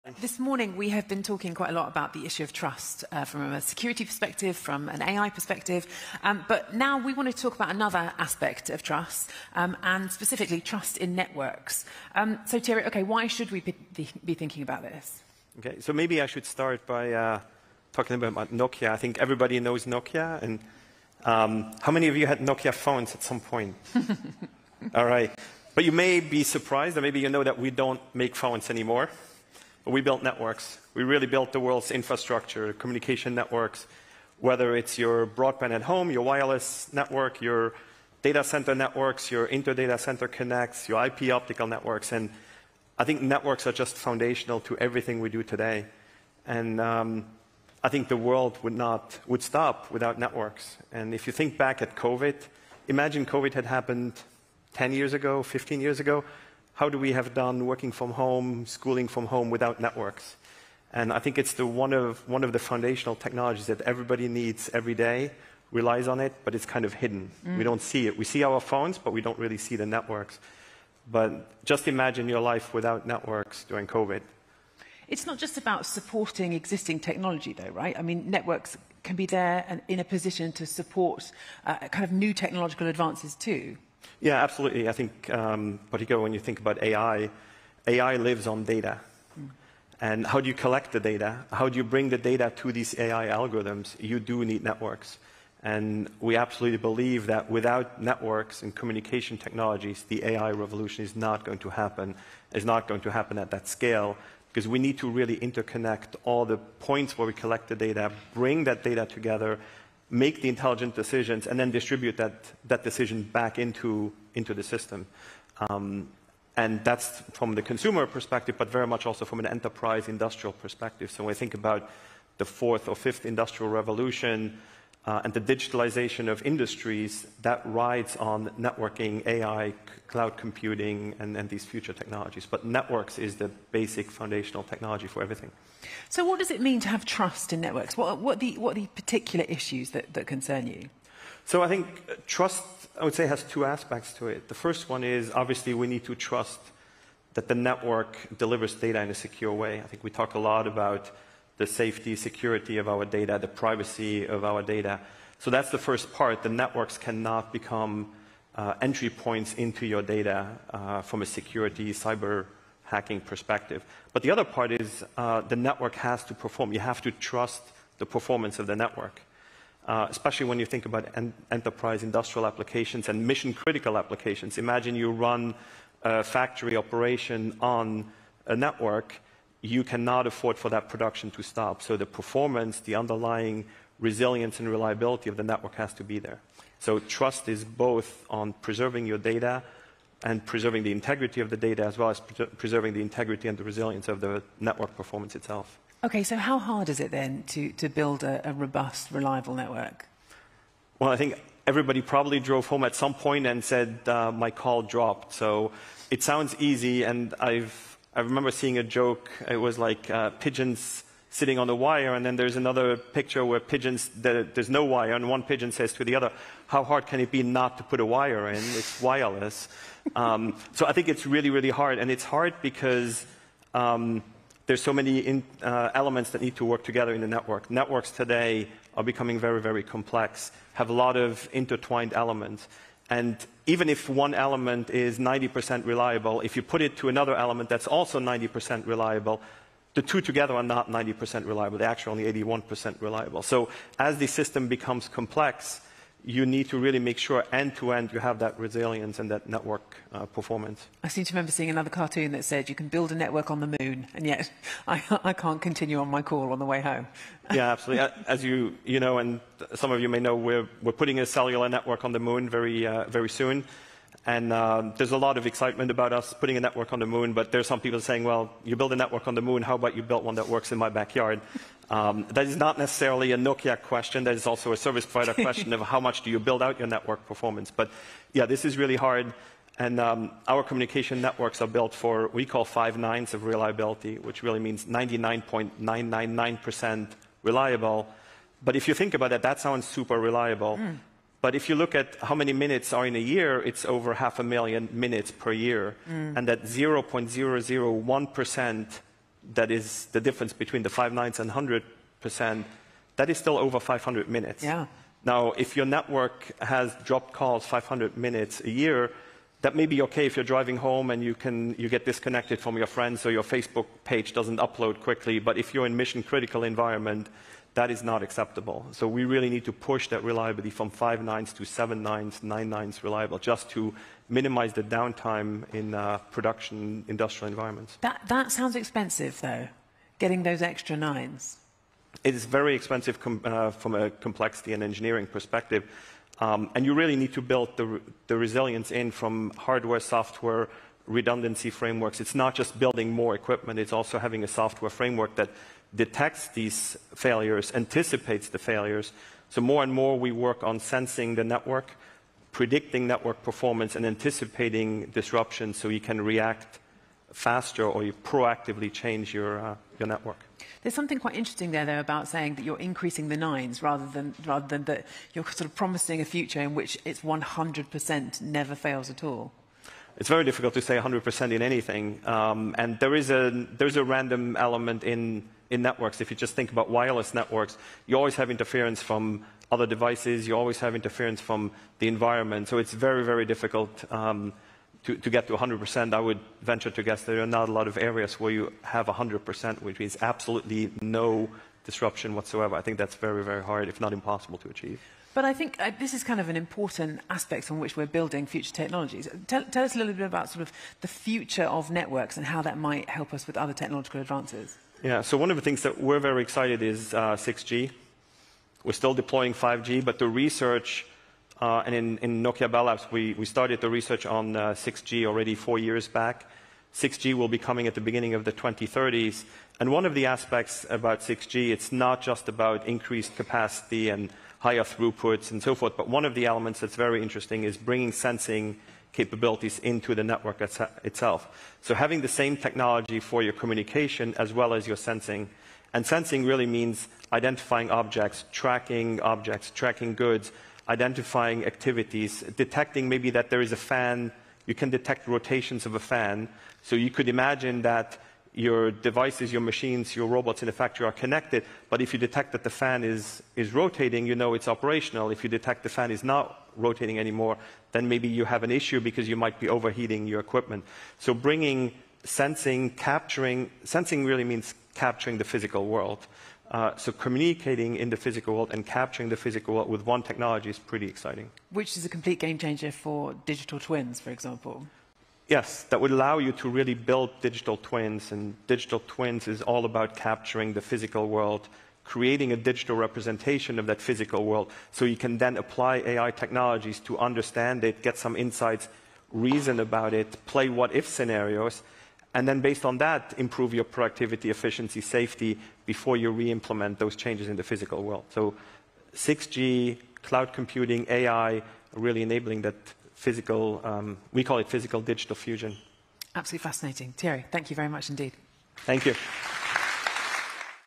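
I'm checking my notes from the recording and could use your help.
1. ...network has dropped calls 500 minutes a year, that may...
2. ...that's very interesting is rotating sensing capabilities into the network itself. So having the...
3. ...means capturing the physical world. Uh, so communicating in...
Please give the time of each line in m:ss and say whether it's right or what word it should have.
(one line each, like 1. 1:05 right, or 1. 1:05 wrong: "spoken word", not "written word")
1. 5:05 right
2. 7:06 wrong: "bringing", not "rotating"
3. 7:44 right.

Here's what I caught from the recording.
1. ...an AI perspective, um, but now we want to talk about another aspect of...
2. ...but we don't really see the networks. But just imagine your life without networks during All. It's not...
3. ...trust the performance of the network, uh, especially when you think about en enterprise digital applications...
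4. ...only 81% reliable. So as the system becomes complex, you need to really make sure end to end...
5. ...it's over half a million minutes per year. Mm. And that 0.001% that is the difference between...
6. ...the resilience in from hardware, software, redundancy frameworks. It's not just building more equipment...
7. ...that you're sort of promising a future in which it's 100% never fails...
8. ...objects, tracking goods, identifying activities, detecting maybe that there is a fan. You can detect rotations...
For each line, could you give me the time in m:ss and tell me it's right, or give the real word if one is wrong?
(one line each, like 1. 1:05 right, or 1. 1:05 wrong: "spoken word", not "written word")
1. 0:04 right
2. 1:08 wrong: "COVID", not "All"
3. 2:47 wrong: "industrial", not "digital"
4. 4:02 right
5. 4:53 right
6. 5:38 right
7. 6:04 right
8. 7:19 right.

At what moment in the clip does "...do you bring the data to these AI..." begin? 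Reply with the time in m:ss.
1:31.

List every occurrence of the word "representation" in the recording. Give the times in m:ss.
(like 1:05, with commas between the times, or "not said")
8:02.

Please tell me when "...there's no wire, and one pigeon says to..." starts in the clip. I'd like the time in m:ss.
3:34.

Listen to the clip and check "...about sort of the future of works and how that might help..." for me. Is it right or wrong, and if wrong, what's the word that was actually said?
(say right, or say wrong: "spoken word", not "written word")
wrong: "networks", not "works".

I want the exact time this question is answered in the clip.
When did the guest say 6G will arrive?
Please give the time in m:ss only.
6:58.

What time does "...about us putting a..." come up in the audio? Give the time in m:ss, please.
4:25.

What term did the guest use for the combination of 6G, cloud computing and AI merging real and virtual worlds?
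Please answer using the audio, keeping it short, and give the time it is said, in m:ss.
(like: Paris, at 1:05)
physical digital fusion, at 8:24.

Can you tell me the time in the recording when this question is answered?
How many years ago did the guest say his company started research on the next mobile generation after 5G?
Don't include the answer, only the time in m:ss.
6:55.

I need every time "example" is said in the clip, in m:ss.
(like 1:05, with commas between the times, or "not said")
7:54.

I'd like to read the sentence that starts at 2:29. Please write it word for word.
I think we talk a lot about the safety, security of our data, the privacy of our data.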